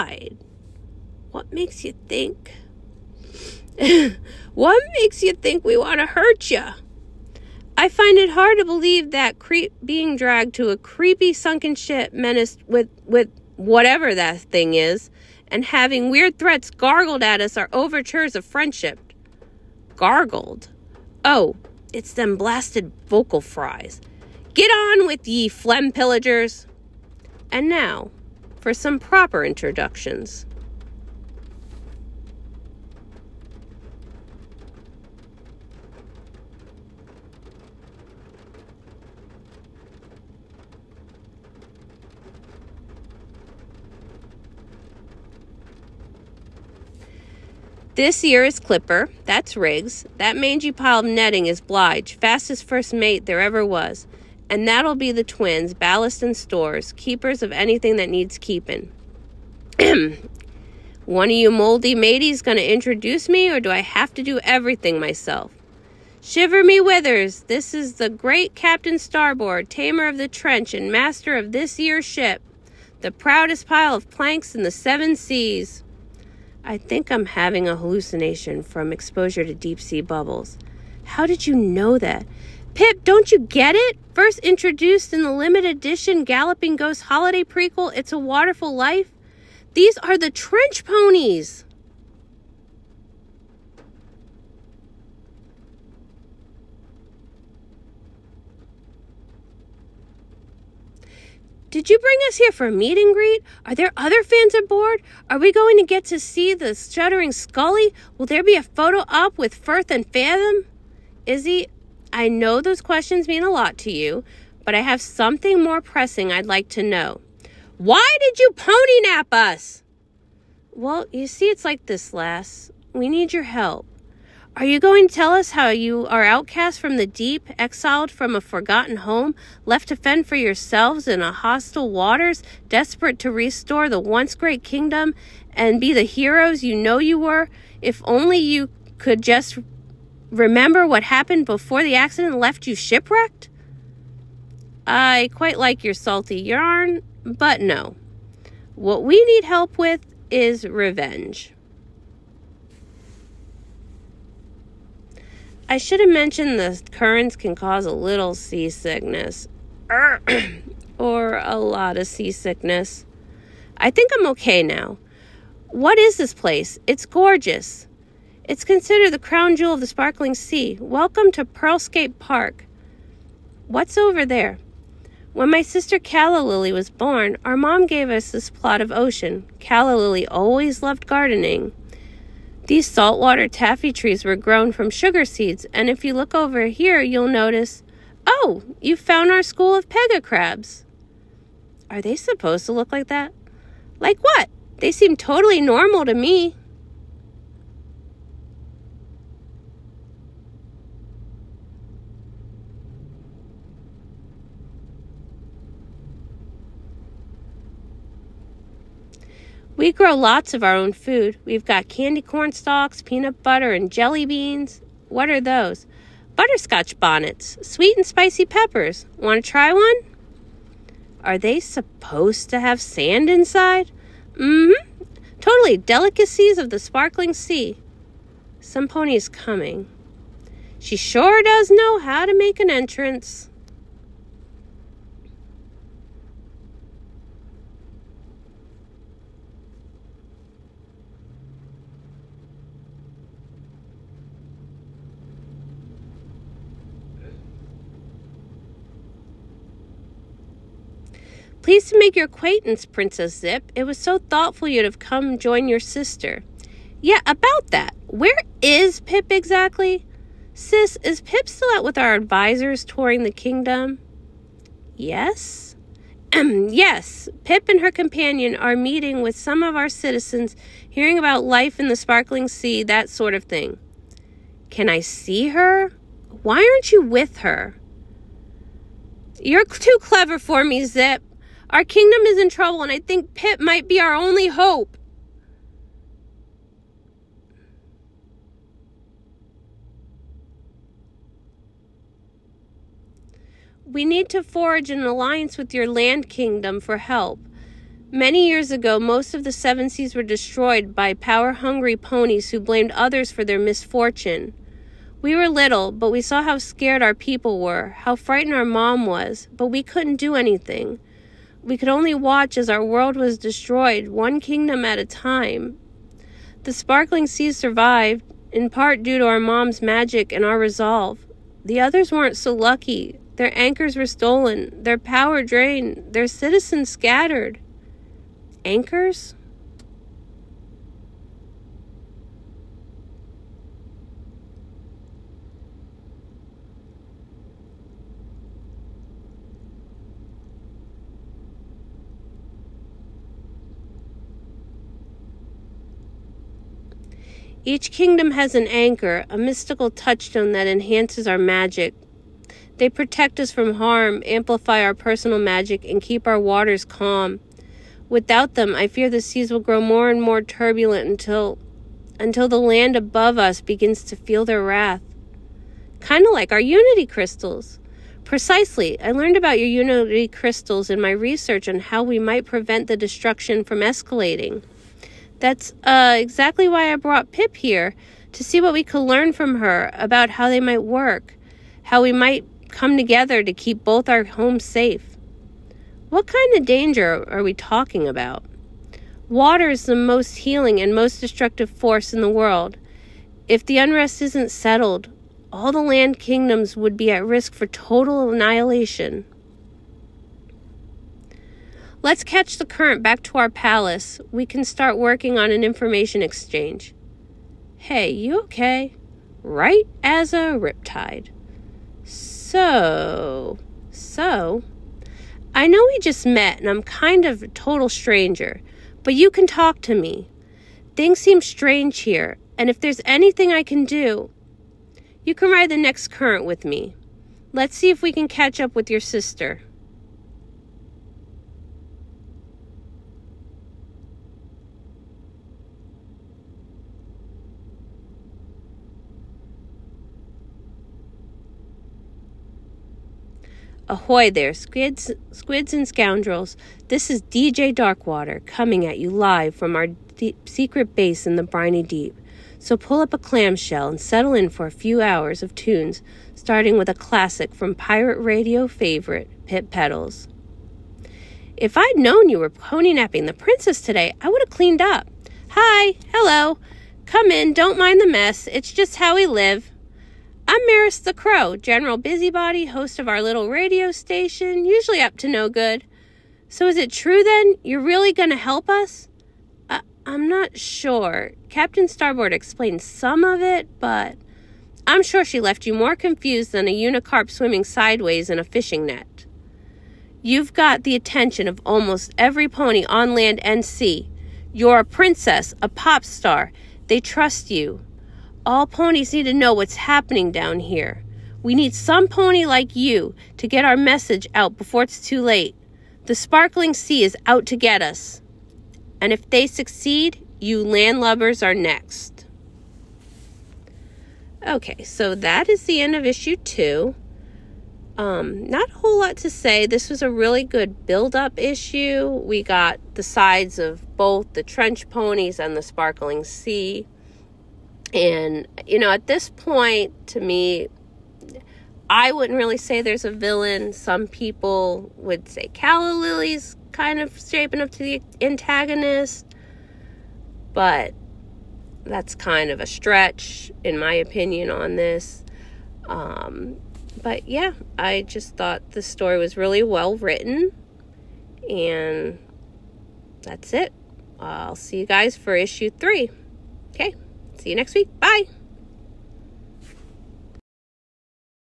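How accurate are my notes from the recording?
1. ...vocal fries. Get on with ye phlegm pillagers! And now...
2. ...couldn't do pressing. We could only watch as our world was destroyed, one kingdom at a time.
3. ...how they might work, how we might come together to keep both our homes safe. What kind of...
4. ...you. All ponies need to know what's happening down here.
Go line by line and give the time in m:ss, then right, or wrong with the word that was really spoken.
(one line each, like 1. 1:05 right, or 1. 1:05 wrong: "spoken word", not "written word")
1. 0:23 right
2. 5:09 wrong: "anything", not "pressing"
3. 6:20 right
4. 8:17 right.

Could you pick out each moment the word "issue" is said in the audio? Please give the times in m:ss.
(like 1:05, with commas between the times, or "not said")
8:36, 8:41, 9:15.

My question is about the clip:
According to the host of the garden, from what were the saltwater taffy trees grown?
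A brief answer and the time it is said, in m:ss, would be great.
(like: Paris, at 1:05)
sugar seeds, at 3:04.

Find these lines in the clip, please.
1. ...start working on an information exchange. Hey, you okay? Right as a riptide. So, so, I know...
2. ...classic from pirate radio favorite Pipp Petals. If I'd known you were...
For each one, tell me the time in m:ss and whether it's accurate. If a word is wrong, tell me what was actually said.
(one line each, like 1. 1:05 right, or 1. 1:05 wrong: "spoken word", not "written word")
1. 6:44 right
2. 7:36 right.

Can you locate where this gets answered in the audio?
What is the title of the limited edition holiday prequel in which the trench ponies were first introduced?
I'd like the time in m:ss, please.
1:27.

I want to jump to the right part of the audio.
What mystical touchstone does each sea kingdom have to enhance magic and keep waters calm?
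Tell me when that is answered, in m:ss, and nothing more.
5:48.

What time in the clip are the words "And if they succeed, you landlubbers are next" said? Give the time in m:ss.
8:28.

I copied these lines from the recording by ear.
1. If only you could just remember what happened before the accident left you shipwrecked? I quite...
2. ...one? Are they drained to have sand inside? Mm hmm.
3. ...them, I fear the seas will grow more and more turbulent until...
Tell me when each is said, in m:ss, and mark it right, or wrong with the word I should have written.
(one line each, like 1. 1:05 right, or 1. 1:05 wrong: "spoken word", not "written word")
1. 2:17 right
2. 3:39 wrong: "supposed", not "drained"
3. 5:58 right.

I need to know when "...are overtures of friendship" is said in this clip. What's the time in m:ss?
0:17.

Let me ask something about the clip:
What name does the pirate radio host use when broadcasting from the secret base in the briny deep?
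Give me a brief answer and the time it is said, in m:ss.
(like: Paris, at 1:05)
DJ Darkwater, at 7:27.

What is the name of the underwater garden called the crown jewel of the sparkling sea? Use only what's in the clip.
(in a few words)
Pearlscape Park.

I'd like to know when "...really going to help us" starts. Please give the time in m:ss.
7:57.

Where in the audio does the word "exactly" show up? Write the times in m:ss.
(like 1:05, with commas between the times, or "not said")
4:19, 6:16.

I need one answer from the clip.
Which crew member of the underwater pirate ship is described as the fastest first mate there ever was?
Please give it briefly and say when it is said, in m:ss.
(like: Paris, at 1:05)
Blige, at 0:51.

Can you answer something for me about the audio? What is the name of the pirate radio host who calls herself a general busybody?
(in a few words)
Maris the Crow.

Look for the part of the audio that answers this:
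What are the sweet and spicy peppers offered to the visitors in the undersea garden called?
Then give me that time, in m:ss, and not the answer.
3:36.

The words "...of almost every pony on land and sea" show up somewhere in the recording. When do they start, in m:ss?
8:11.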